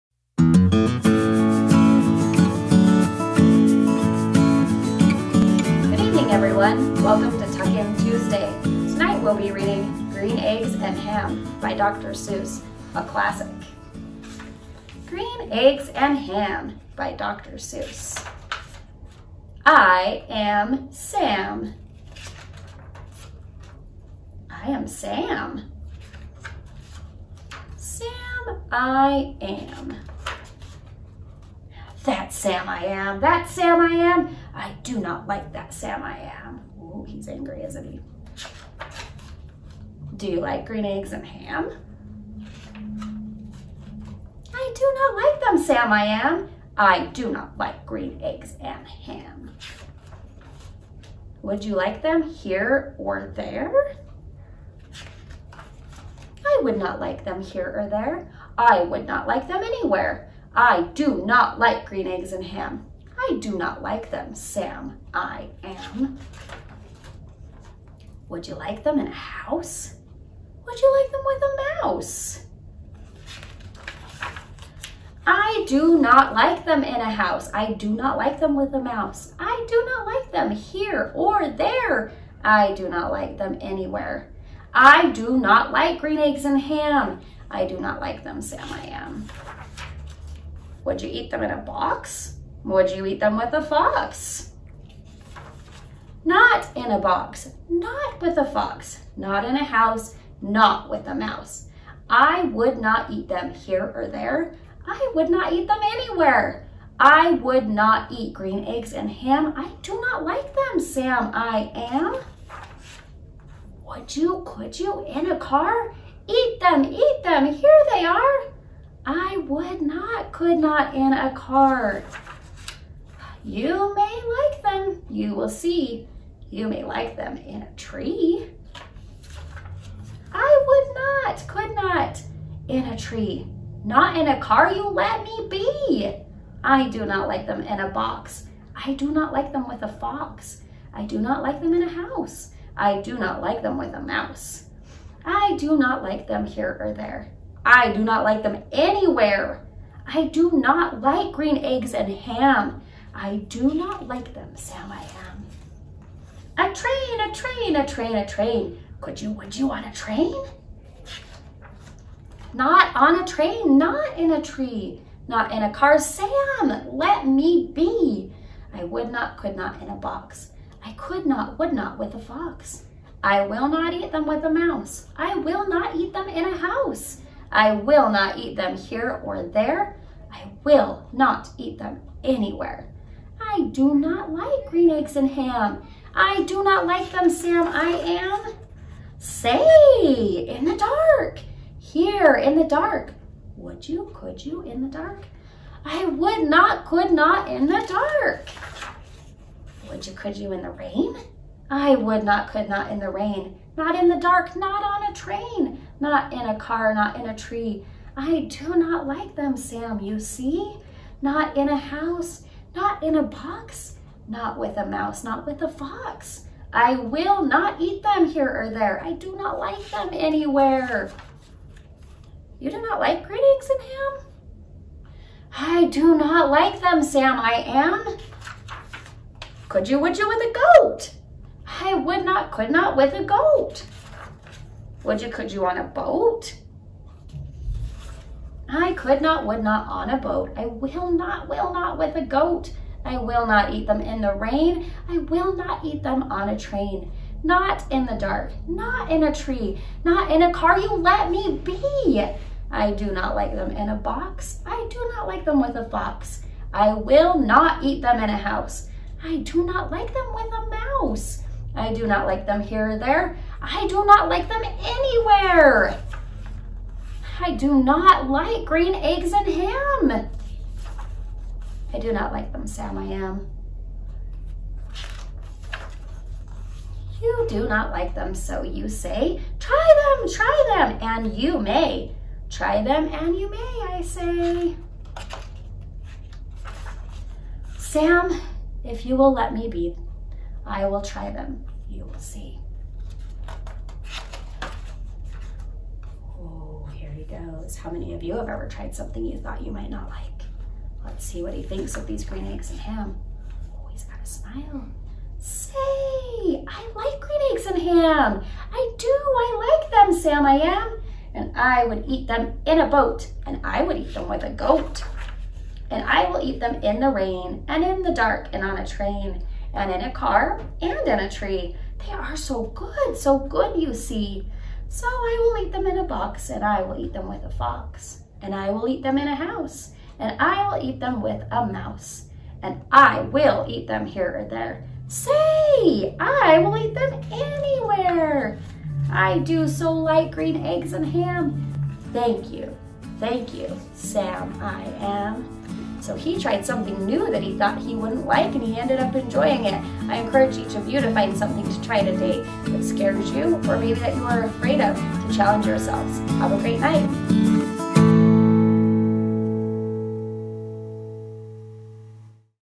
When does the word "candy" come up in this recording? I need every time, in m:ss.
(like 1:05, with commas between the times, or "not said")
not said.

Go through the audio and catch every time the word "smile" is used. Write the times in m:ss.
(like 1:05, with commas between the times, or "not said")
5:04.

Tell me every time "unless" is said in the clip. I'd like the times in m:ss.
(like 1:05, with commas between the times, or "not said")
not said.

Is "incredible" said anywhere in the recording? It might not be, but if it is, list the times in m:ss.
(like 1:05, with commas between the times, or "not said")
not said.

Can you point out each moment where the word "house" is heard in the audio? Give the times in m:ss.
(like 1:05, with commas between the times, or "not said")
1:09, 1:17, 1:39, 2:21, 2:56, 3:31, 4:18, 5:29.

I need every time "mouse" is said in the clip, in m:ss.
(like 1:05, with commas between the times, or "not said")
1:11, 1:18, 1:41, 2:24, 2:54, 3:34, 4:21, 5:31.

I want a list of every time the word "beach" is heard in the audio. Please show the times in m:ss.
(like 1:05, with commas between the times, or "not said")
not said.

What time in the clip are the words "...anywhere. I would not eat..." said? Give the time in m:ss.
1:45.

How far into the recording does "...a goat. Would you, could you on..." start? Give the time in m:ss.
3:53.